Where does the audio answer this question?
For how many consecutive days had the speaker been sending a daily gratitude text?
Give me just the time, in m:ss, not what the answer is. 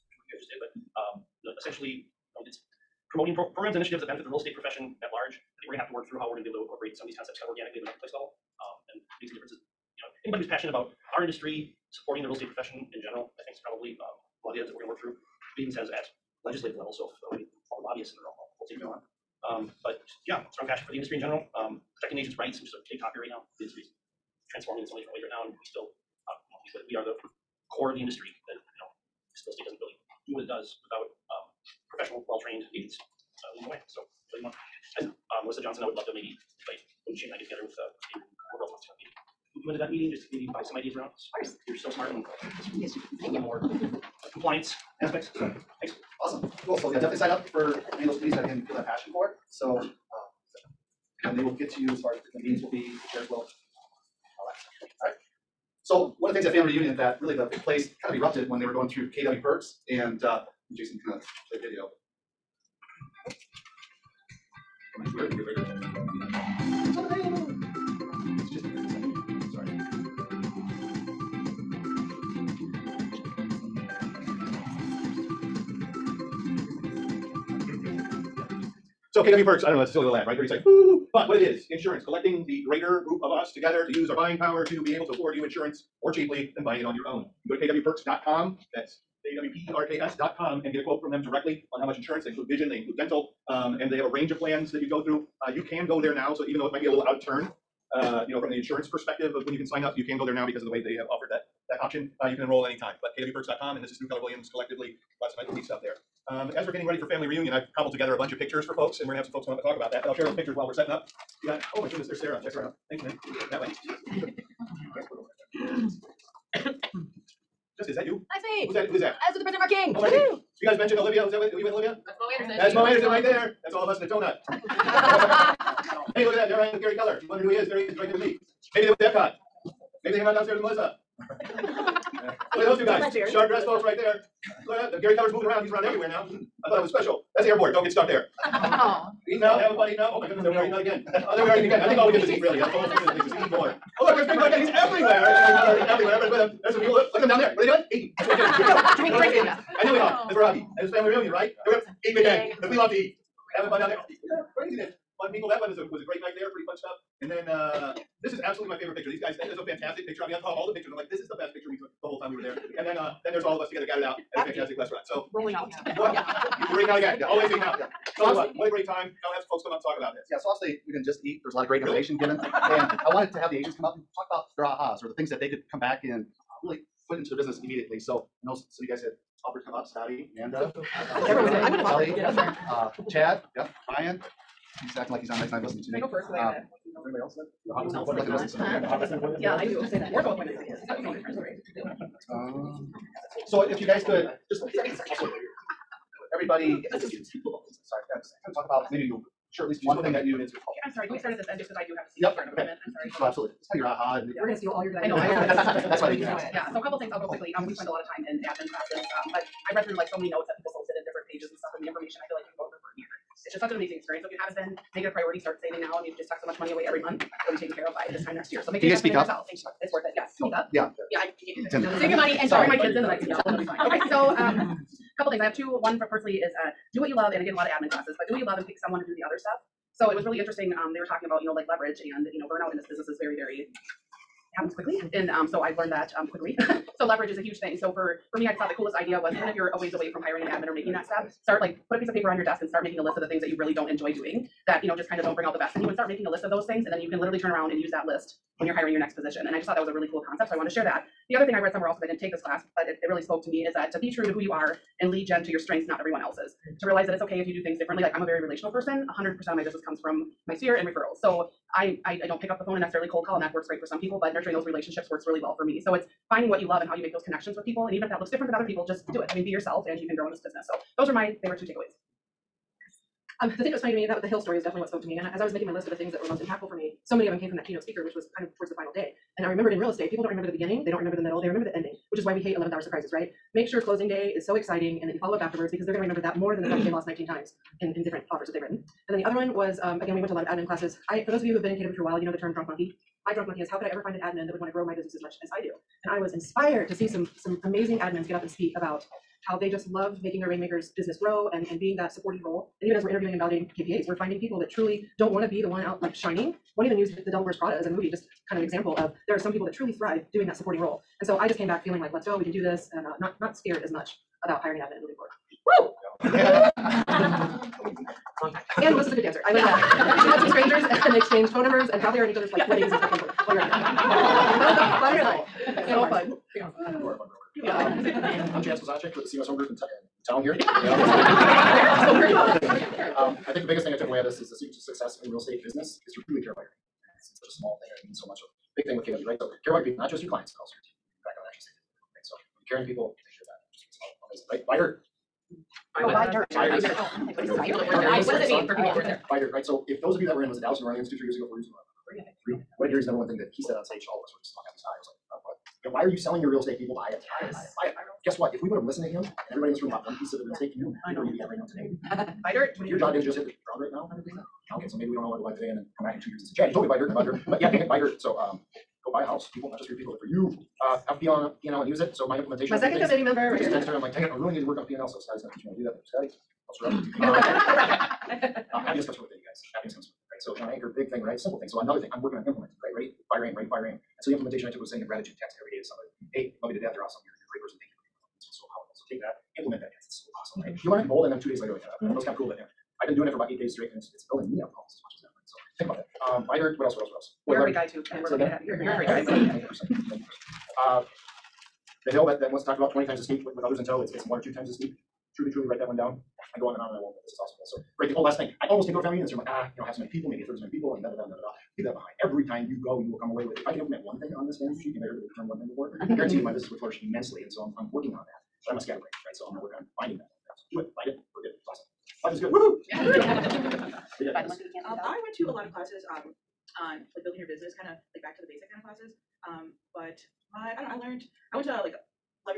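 6:33.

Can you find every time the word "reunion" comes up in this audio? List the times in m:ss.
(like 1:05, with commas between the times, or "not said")
0:56, 1:47, 2:31, 6:49.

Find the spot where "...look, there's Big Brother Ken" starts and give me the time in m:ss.
2:24.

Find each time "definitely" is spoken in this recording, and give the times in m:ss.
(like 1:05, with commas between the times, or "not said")
0:46, 4:34.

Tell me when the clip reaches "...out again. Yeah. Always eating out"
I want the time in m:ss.
2:46.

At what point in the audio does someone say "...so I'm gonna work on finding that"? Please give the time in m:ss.
6:59.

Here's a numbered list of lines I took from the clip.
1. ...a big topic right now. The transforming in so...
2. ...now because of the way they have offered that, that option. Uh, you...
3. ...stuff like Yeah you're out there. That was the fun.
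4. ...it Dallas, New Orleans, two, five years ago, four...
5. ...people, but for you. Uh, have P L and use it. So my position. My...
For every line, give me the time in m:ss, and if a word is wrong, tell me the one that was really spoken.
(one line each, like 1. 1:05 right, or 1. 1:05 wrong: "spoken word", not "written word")
1. 0:22 right
2. 1:40 right
3. 5:22 wrong: "While", not "Yeah"
4. 5:50 wrong: "three", not "five"
5. 6:09 wrong: "implementation", not "position".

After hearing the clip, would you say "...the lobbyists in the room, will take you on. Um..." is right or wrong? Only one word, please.
right.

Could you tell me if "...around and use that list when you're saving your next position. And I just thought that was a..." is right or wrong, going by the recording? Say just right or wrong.
wrong.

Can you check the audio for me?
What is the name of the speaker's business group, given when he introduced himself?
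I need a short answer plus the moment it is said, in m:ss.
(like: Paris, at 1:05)
CMS Home Group, at 5:29.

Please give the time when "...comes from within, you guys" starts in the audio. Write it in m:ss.
6:19.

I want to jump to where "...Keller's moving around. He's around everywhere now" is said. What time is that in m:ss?
2:15.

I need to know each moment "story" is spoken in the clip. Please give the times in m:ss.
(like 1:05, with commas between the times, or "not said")
4:34.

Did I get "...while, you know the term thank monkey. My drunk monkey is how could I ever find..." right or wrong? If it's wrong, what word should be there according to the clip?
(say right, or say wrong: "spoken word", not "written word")
wrong: "drunk", not "thank".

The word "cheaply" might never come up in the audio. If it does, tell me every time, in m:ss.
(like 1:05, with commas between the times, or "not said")
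1:26.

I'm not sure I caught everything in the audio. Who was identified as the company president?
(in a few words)
Mark King.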